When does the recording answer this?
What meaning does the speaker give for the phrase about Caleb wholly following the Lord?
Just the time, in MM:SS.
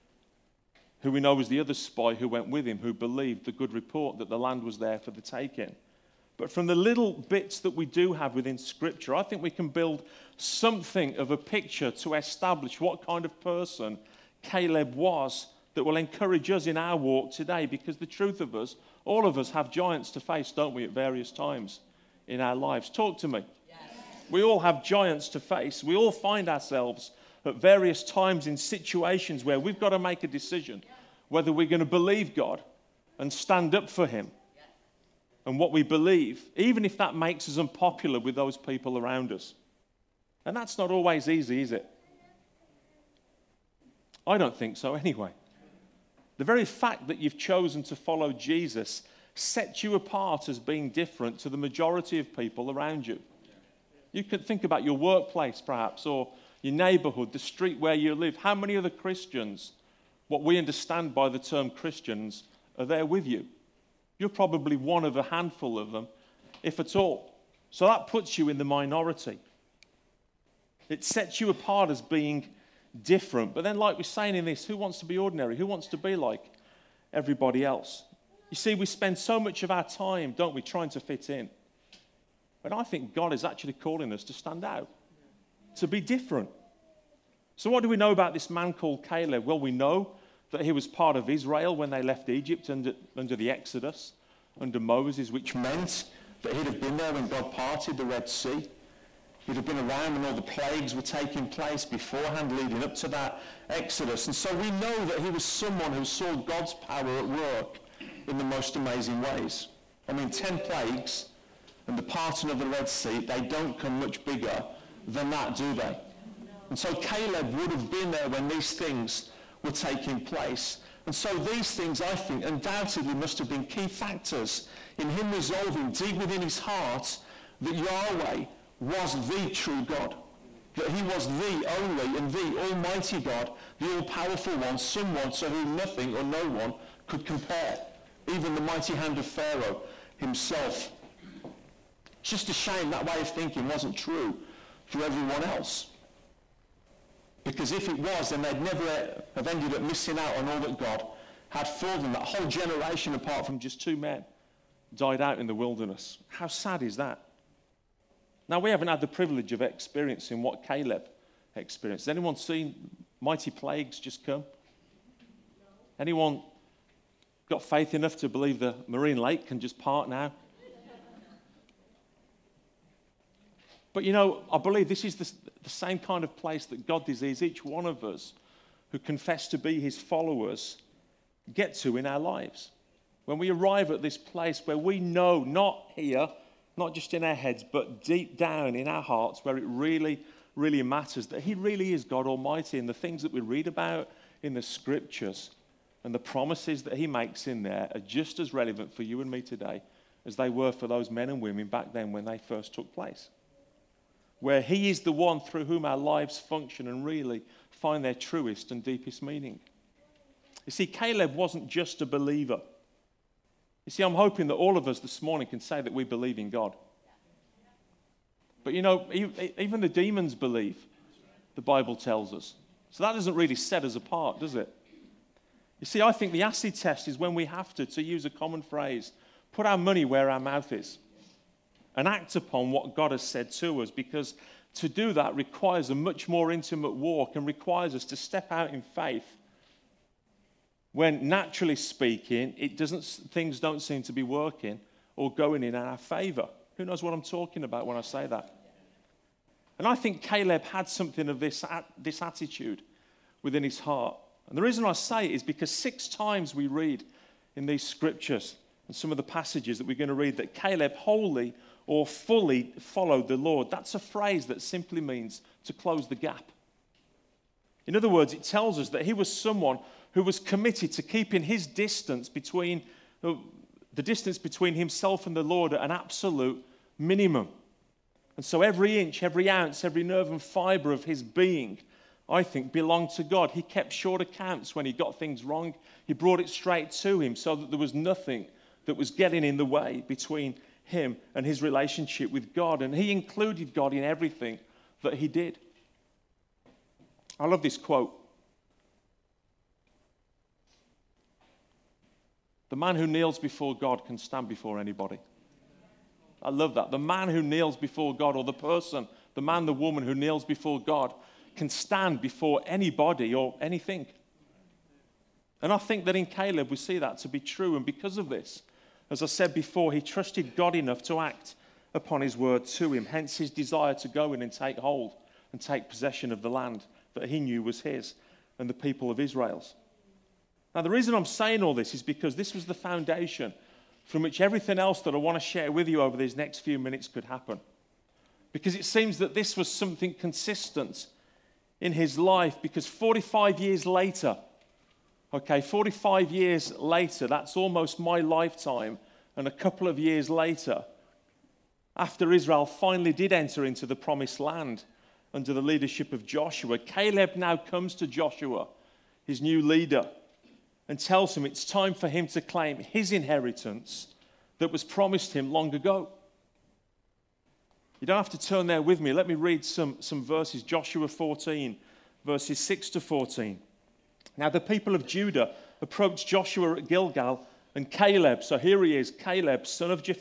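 04:25.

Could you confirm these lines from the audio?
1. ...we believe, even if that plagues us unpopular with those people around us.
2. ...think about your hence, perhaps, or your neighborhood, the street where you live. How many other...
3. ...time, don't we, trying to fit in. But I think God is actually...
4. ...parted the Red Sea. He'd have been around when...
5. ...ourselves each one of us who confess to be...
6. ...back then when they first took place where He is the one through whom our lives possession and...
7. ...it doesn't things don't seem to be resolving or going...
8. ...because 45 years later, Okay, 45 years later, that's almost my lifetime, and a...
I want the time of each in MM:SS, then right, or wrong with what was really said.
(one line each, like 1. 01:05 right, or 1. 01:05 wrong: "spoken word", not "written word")
1. 00:35 wrong: "makes", not "plagues"
2. 00:54 wrong: "workplace", not "hence"
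3. 01:19 right
4. 01:37 right
5. 02:57 wrong: "desires", not "ourselves"
6. 03:21 wrong: "function", not "possession"
7. 04:02 wrong: "working", not "resolving"
8. 05:42 right.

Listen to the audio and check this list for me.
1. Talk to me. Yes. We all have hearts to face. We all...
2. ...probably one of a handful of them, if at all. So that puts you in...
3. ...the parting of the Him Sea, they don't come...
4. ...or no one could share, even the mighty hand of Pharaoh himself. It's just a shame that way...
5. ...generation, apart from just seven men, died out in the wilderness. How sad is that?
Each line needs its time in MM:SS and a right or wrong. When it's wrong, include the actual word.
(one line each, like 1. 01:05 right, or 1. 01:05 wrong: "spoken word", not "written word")
1. 00:22 wrong: "giants", not "hearts"
2. 01:04 right
3. 01:51 wrong: "Red", not "Him"
4. 02:16 wrong: "compare", not "share"
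5. 02:32 wrong: "two", not "seven".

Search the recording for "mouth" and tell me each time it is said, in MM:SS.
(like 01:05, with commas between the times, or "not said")
03:50.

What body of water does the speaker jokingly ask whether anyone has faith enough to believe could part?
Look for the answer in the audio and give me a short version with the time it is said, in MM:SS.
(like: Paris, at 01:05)
the marine lake, at 02:48.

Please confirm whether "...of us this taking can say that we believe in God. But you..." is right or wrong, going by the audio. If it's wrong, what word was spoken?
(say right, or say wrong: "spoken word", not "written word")
wrong: "morning", not "taking".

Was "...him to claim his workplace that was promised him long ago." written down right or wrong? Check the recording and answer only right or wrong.
wrong.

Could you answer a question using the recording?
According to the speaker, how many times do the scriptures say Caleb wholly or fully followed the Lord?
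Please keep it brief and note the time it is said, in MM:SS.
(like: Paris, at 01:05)
6, at 04:15.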